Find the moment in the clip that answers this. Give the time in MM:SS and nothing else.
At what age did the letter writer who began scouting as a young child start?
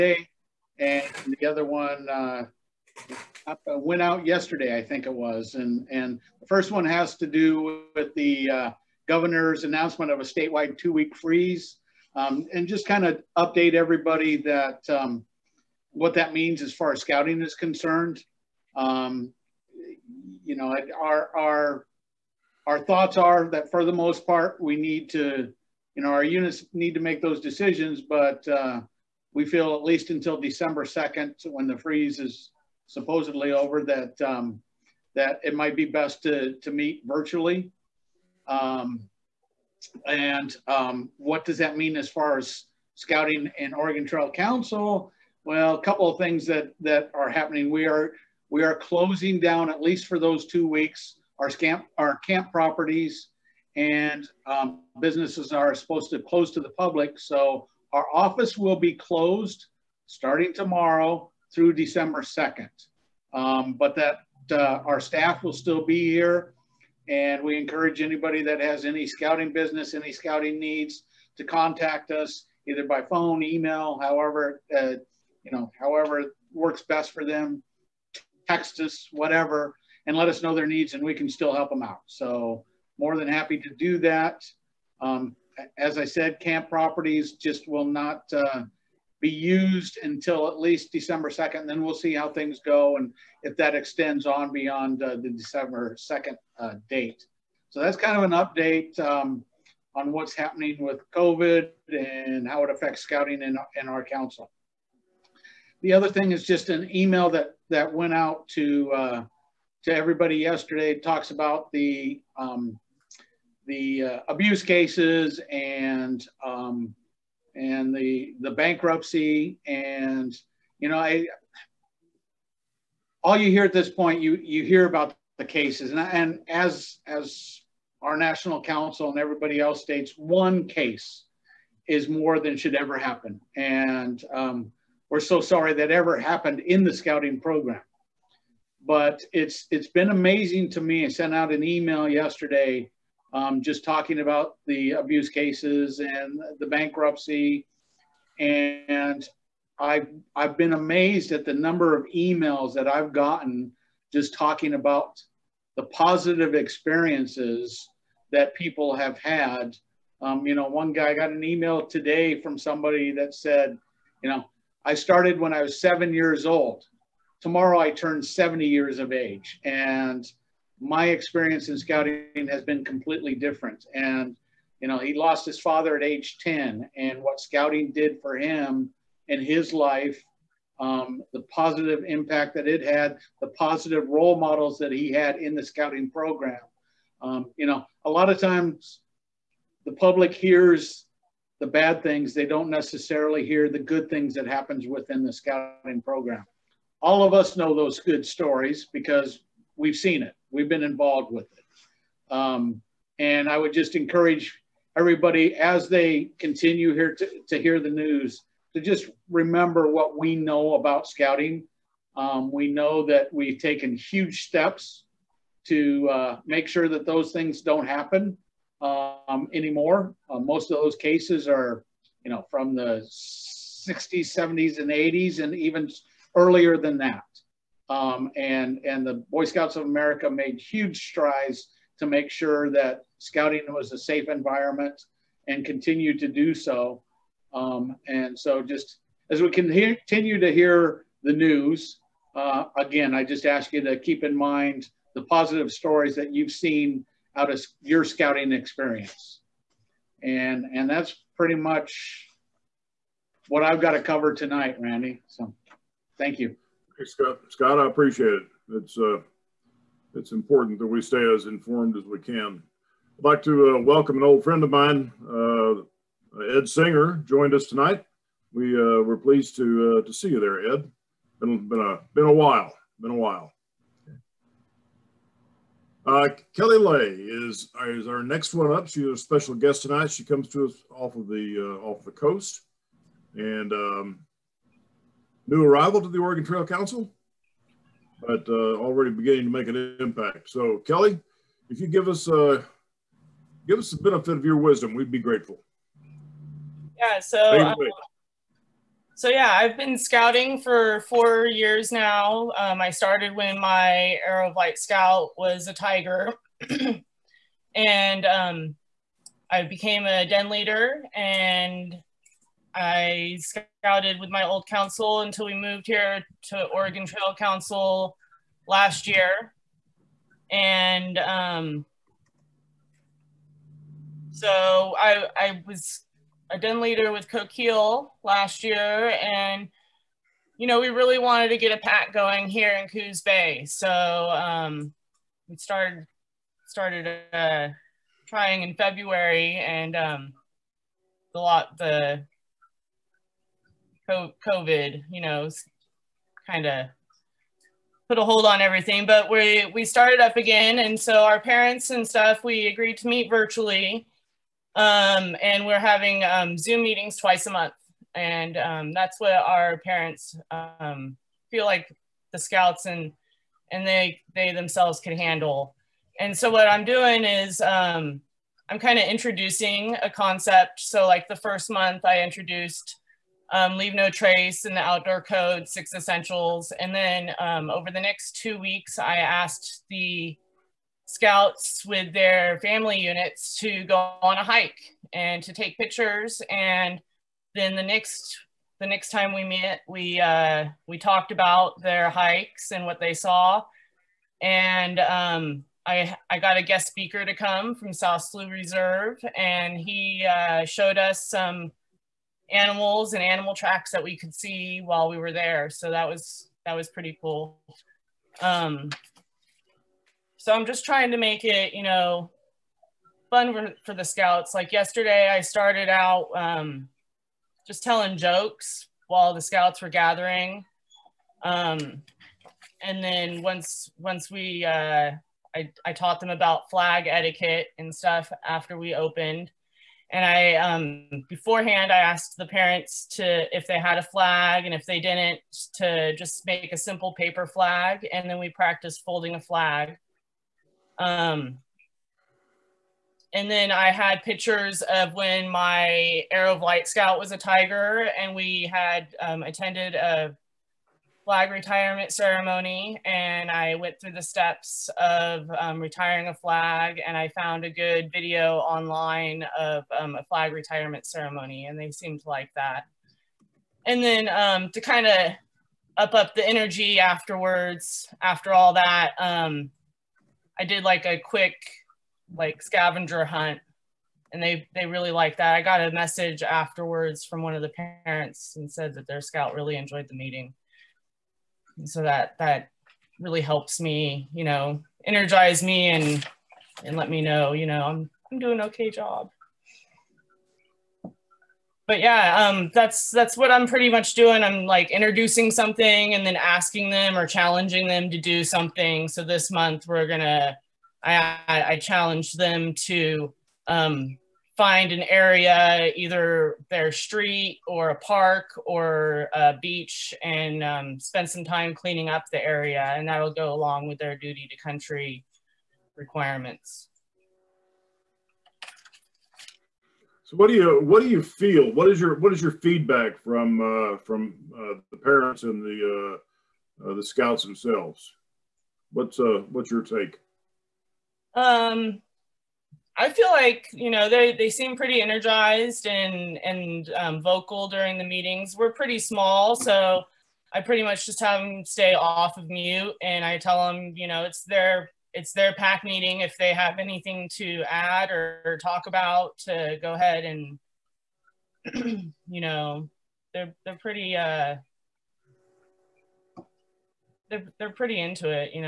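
02:45.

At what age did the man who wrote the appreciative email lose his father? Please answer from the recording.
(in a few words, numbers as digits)
10.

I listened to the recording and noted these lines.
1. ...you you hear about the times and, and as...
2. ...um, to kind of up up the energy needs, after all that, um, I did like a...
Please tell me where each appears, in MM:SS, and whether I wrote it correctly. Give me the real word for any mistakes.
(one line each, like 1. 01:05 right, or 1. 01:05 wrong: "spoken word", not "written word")
1. 02:04 wrong: "cases", not "times"
2. 07:44 wrong: "afterwards", not "needs".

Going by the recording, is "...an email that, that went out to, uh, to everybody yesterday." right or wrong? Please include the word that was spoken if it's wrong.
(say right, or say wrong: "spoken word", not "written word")
right.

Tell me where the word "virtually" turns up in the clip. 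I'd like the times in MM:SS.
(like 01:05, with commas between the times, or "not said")
00:37, 05:53.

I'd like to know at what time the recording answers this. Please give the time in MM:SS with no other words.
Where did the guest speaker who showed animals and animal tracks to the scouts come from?
06:37.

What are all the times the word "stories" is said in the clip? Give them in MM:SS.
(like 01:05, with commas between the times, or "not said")
03:18, 04:05.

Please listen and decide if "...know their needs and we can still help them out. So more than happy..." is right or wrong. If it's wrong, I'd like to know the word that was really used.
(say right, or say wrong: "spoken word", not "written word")
right.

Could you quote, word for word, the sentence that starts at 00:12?
Um, and just kind of update everybody that um, what that means as far as scouting is concerned.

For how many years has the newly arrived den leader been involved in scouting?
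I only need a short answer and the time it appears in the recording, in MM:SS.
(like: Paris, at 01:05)
4 years, at 05:01.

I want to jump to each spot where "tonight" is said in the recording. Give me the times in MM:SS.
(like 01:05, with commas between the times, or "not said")
04:14, 04:27, 04:39.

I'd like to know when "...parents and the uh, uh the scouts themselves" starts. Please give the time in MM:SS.
08:44.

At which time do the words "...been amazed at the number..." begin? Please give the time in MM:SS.
02:30.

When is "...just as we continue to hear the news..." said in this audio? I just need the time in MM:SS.
03:58.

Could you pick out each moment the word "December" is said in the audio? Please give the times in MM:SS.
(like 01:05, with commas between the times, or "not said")
00:30, 01:01, 01:30, 01:35.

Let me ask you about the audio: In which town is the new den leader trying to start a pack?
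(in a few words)
Coos Bay.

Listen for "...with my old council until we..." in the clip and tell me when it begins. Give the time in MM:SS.
05:14.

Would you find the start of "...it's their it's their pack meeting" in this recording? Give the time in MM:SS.
09:04.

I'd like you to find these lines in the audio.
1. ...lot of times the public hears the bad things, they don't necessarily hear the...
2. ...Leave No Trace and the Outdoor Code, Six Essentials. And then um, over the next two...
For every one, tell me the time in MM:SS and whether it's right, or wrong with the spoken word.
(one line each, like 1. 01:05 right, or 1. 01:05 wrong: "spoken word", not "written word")
1. 03:08 right
2. 06:13 right.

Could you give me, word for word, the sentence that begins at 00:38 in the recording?
Um, and um, what does that mean as far as scouting and Oregon Trail Council?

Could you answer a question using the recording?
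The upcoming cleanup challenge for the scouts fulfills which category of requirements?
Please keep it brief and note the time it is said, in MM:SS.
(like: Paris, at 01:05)
duty to country, at 08:34.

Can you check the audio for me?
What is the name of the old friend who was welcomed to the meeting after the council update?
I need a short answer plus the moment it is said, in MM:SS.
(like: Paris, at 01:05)
Ed Singer, at 04:26.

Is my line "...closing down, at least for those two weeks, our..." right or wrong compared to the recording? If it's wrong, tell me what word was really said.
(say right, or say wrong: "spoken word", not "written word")
right.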